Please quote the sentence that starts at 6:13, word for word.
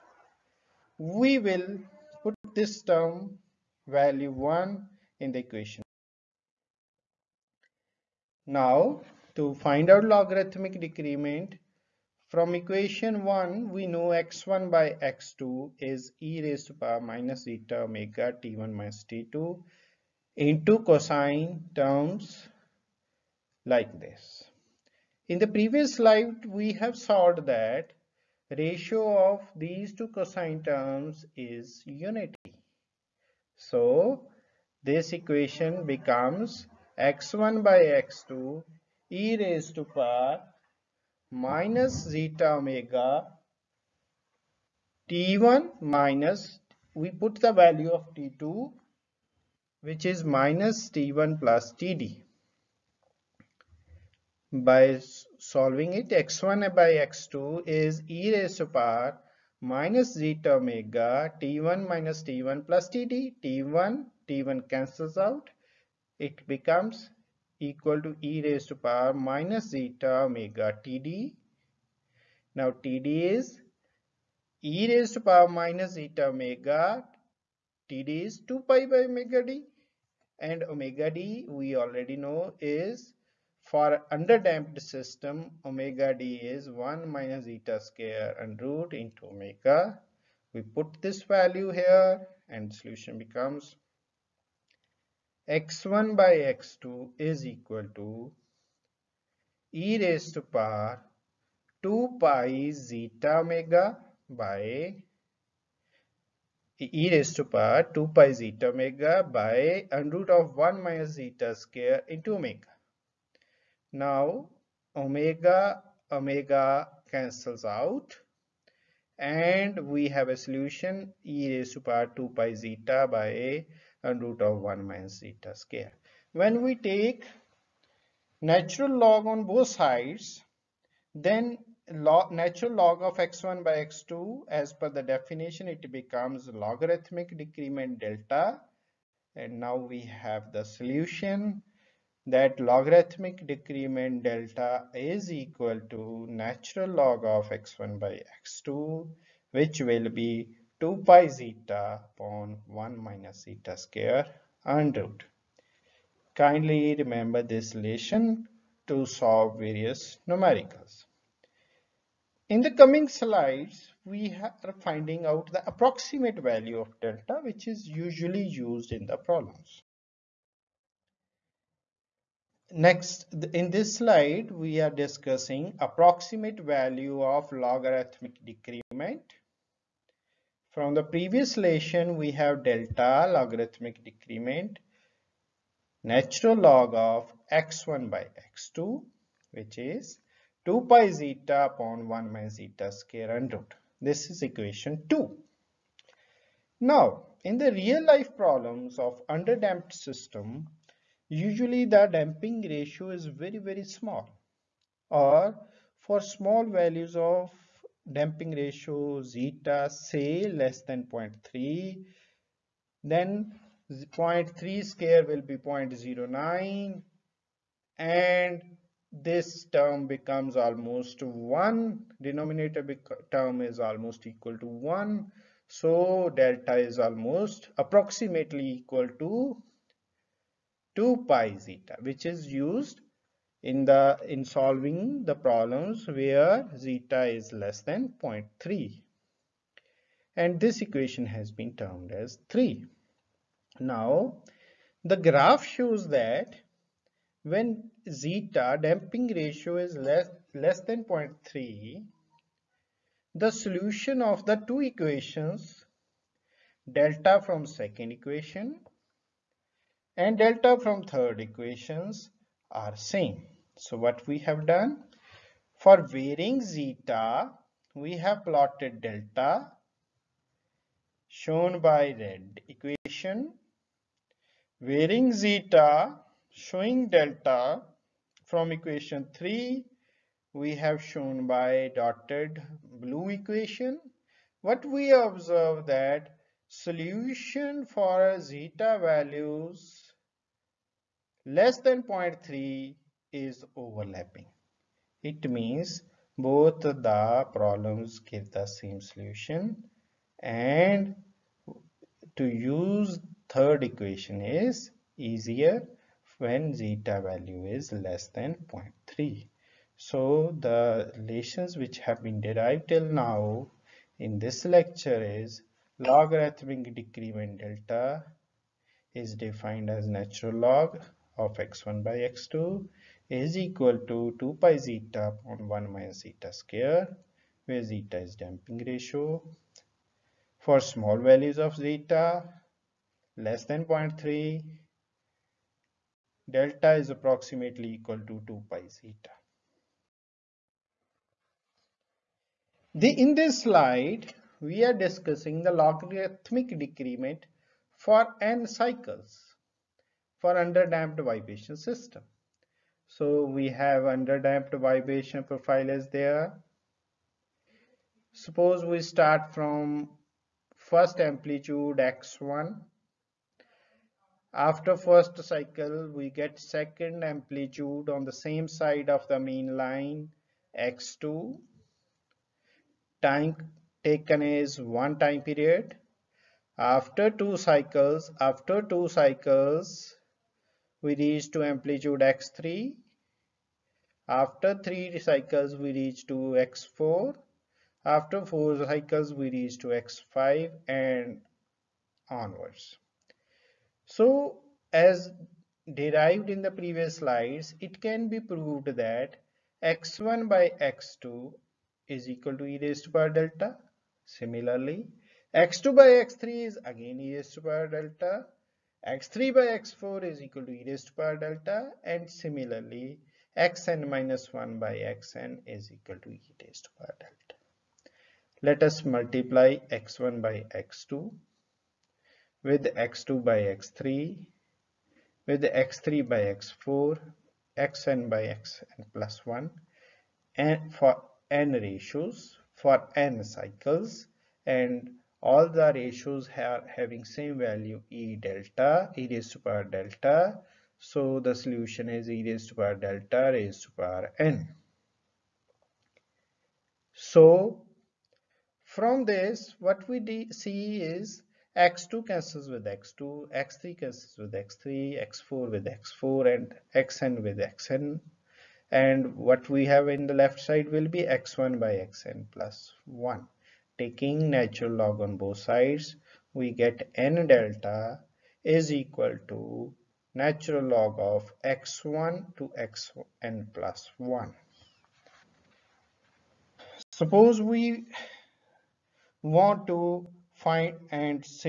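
Time taken is one time period.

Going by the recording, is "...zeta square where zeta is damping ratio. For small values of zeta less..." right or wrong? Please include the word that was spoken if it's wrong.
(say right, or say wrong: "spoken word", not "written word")
right.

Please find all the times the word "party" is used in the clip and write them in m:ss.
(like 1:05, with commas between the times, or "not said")
not said.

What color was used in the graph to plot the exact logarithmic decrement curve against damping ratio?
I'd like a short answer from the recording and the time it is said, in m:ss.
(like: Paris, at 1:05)
red, at 4:32.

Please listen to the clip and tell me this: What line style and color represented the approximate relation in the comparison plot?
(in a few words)
dotted blue.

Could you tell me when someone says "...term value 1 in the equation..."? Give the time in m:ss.
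0:02.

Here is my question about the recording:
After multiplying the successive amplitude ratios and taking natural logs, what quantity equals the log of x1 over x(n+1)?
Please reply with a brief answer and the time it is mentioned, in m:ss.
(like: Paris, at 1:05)
n delta, at 7:47.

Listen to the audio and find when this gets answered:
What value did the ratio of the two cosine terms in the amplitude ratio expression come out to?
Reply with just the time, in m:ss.
0:31.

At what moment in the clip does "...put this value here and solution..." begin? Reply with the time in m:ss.
1:30.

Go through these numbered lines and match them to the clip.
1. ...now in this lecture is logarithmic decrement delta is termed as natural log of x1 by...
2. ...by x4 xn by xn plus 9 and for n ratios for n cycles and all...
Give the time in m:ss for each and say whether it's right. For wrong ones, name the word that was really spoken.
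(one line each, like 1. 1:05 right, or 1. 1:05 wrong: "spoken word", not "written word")
1. 5:13 wrong: "defined", not "termed"
2. 7:06 wrong: "1", not "9".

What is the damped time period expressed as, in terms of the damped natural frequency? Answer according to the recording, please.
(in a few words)
2 pi by omega d.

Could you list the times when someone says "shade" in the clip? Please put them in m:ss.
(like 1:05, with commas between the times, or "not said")
not said.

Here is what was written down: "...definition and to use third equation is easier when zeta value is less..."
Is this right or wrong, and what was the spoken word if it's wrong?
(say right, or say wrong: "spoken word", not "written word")
wrong: "solution", not "definition".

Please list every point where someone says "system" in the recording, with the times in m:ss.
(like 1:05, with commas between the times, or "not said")
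1:24, 3:19, 5:51.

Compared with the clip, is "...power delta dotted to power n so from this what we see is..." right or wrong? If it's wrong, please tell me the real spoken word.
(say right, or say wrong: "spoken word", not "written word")
wrong: "raised", not "dotted".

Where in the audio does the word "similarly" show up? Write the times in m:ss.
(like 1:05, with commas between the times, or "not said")
6:44, 6:52.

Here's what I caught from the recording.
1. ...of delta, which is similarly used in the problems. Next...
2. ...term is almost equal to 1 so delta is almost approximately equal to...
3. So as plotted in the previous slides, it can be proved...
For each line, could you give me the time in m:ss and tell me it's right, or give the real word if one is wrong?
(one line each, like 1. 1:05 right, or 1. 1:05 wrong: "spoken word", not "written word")
1. 2:46 wrong: "usually", not "similarly"
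2. 3:43 right
3. 6:34 wrong: "derived", not "plotted".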